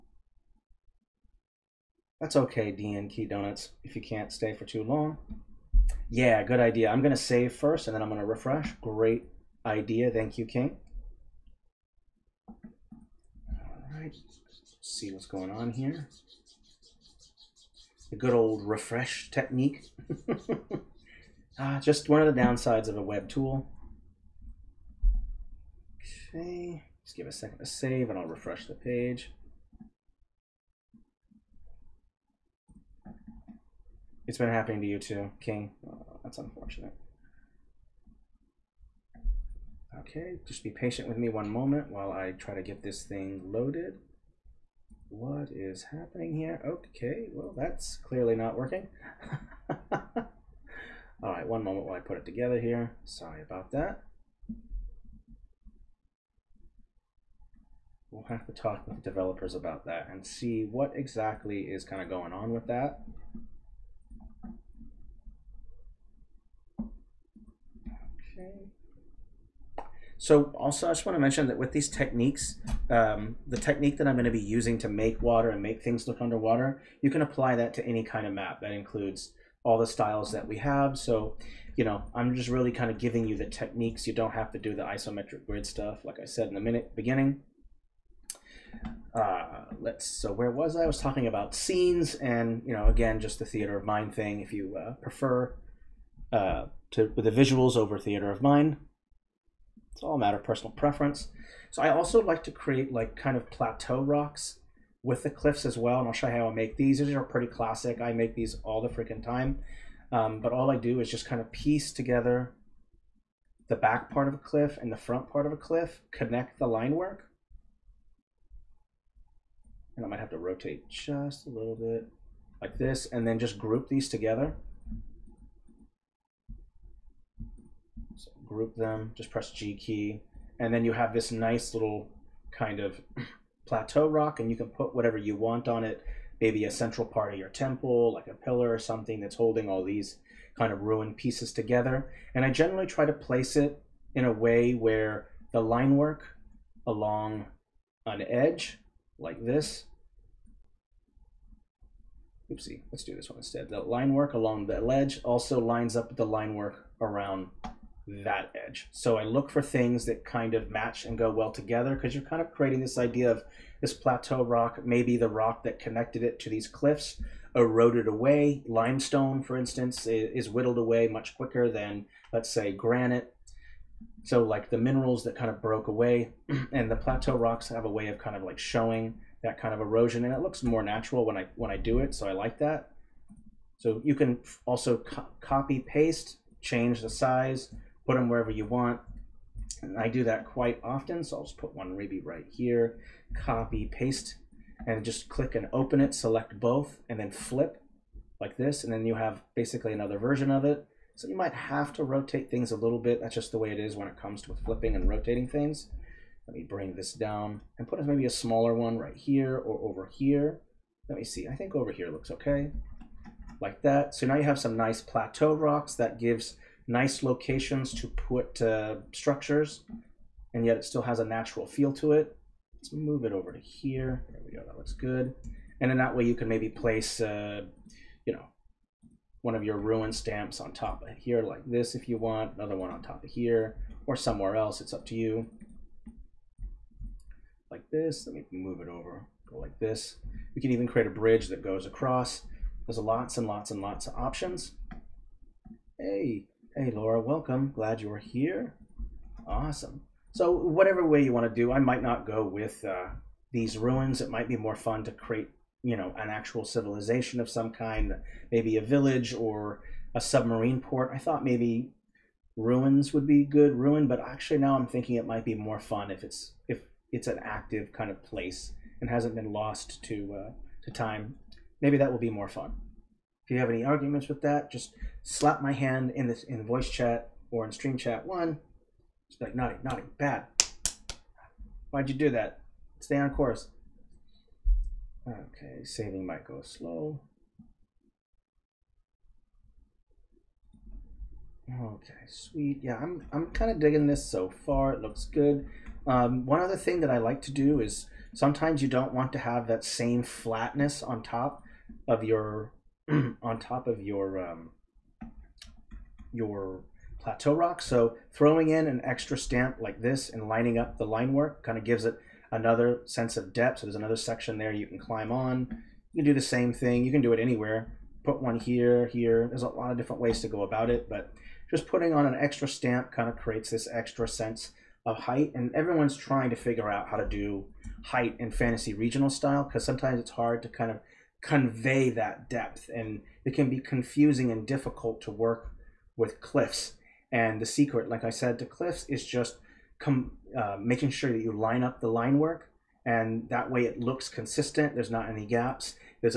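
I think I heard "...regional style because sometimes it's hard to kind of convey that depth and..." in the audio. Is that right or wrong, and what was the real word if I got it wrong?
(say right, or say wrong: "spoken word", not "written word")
right.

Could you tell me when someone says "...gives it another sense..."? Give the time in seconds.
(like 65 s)
311 s.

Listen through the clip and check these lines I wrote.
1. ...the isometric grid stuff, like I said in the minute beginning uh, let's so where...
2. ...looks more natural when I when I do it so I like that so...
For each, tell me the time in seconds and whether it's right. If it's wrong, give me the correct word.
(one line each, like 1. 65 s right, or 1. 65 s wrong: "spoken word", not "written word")
1. 84 s right
2. 180 s right.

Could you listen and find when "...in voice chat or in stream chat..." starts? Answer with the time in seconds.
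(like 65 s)
276 s.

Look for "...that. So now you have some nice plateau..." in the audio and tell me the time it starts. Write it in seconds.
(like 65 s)
213 s.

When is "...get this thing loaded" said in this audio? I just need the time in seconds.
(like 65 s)
42 s.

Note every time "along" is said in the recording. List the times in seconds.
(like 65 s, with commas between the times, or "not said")
146 s, 154 s.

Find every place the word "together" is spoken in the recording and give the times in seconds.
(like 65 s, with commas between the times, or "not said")
52 s, 111 s, 124 s, 141 s, 161 s.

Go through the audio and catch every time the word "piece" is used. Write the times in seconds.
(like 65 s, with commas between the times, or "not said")
111 s, 141 s.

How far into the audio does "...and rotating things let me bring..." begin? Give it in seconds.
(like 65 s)
204 s.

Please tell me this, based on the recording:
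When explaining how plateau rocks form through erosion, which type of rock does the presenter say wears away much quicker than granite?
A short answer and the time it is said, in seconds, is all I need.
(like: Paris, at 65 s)
Limestone, at 168 s.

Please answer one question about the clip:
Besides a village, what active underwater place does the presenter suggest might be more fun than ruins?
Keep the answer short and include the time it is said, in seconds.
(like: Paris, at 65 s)
A submarine port, at 260 s.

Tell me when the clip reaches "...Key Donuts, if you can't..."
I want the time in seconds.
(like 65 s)
3 s.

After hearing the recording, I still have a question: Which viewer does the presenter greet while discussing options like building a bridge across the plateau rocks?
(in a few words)
Laura.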